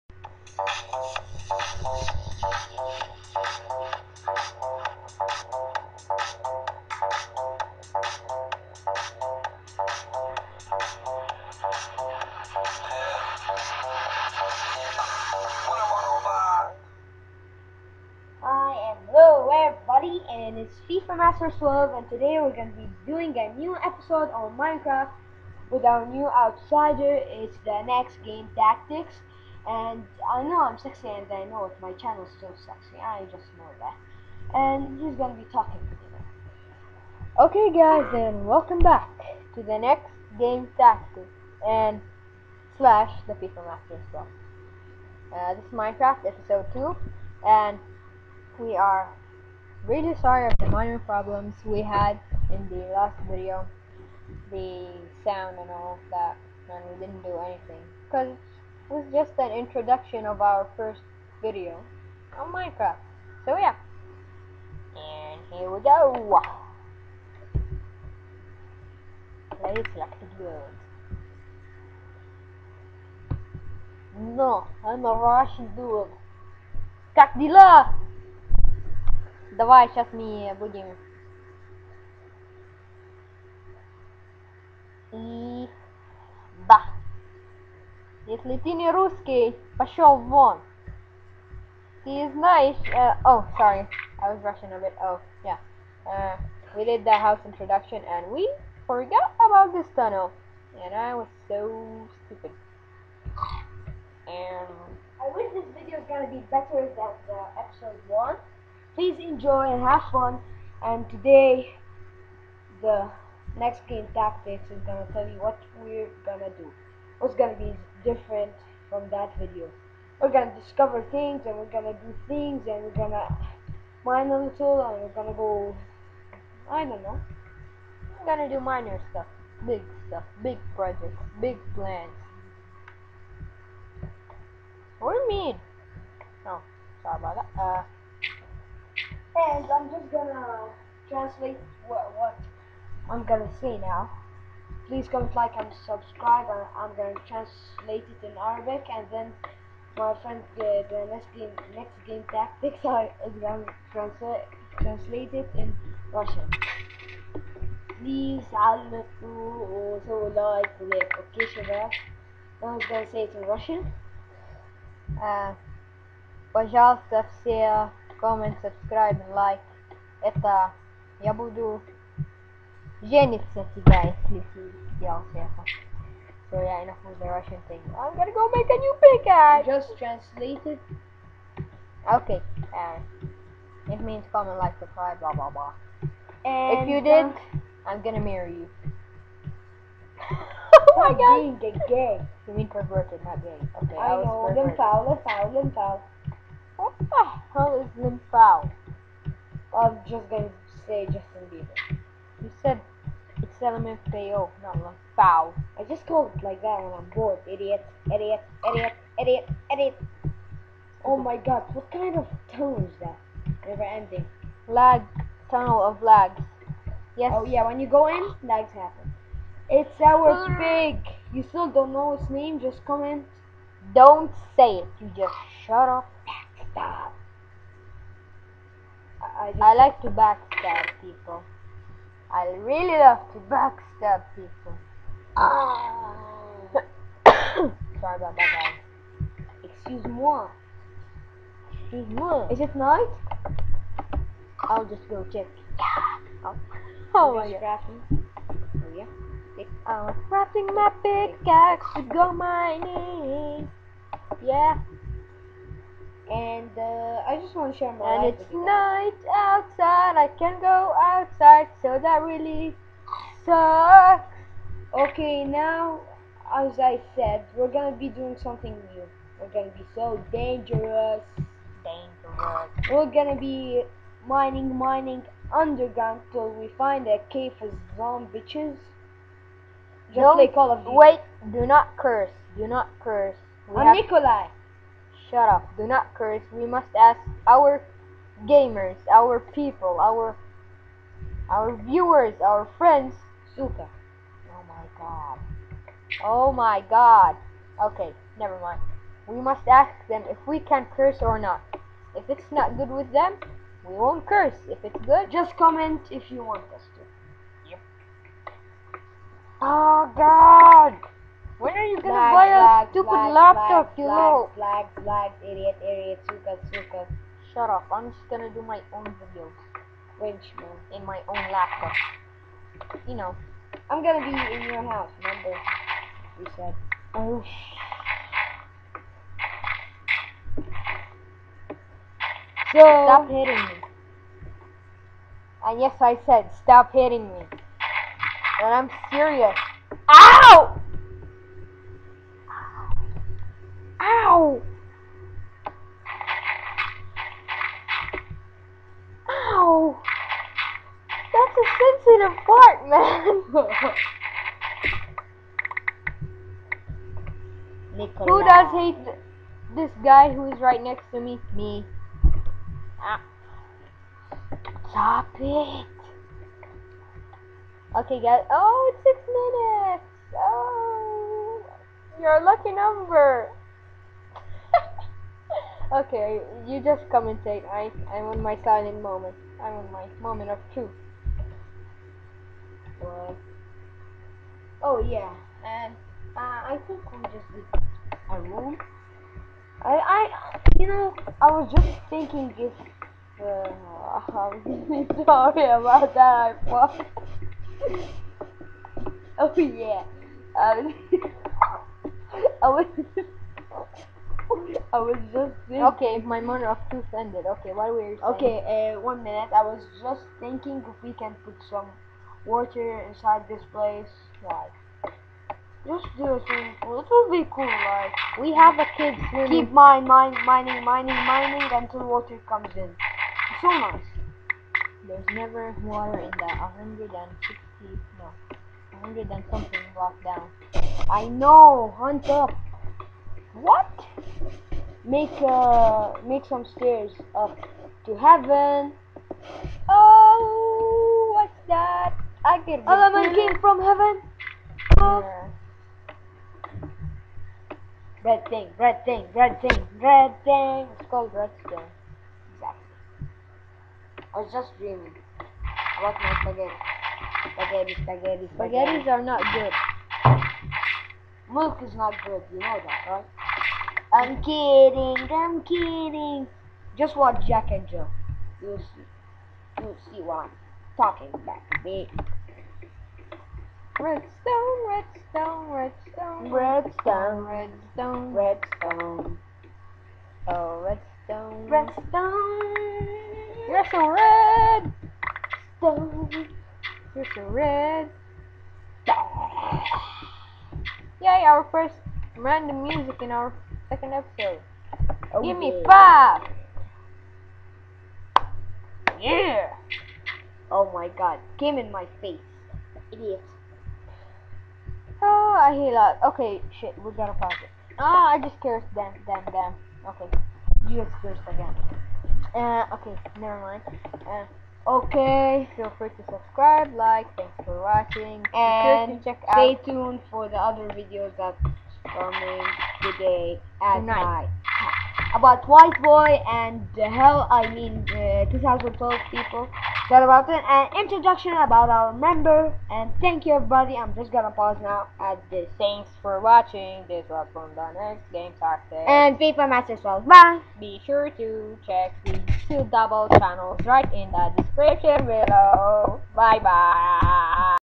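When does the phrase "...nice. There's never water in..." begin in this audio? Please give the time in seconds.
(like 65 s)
423 s.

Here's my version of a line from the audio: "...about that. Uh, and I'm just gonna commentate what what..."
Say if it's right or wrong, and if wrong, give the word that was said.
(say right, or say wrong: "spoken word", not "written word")
wrong: "translate", not "commentate".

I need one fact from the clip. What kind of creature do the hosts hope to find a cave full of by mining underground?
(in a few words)
zombies.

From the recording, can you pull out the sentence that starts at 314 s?
Black, black, black, idiot, idiot, suka, suka.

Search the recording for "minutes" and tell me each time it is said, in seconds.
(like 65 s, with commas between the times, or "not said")
369 s, 409 s.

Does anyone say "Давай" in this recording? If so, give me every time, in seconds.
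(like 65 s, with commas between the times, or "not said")
79 s.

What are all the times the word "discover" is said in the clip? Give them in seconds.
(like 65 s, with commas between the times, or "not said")
120 s.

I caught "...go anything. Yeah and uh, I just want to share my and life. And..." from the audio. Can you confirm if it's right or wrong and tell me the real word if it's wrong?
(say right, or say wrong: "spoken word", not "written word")
wrong: "mining", not "anything".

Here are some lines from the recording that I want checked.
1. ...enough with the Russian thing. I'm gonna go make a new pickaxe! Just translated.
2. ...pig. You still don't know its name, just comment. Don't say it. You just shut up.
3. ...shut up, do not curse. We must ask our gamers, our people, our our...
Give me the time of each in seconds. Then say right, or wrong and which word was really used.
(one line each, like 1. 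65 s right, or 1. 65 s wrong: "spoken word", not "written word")
1. 176 s right
2. 220 s right
3. 285 s right.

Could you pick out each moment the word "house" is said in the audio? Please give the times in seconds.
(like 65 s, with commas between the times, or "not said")
97 s, 324 s.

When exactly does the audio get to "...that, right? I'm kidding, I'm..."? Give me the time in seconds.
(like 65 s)
462 s.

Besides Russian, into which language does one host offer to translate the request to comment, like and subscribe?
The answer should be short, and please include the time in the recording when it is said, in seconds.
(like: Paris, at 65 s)
Arabic, at 148 s.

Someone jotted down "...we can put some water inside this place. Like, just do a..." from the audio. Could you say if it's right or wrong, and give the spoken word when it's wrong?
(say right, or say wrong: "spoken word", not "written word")
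right.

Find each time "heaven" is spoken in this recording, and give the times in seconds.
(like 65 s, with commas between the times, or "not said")
438 s, 443 s.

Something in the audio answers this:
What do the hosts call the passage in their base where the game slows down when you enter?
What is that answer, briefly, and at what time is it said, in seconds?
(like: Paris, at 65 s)
tunnel of lags, at 215 s.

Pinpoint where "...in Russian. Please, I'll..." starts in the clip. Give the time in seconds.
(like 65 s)
155 s.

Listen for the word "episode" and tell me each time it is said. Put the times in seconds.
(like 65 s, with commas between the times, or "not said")
23 s, 46 s, 107 s, 494 s.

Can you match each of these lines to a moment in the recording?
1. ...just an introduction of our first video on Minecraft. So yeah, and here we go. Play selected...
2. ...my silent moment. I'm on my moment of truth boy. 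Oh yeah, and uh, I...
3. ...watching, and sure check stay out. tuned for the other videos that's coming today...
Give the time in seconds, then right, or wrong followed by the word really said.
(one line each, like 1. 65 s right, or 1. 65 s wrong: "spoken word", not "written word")
1. 59 s right
2. 378 s right
3. 517 s right.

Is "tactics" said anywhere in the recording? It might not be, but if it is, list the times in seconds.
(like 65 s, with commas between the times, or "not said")
28 s, 40 s, 114 s, 152 s, 538 s.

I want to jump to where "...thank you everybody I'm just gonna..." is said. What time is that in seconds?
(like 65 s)
533 s.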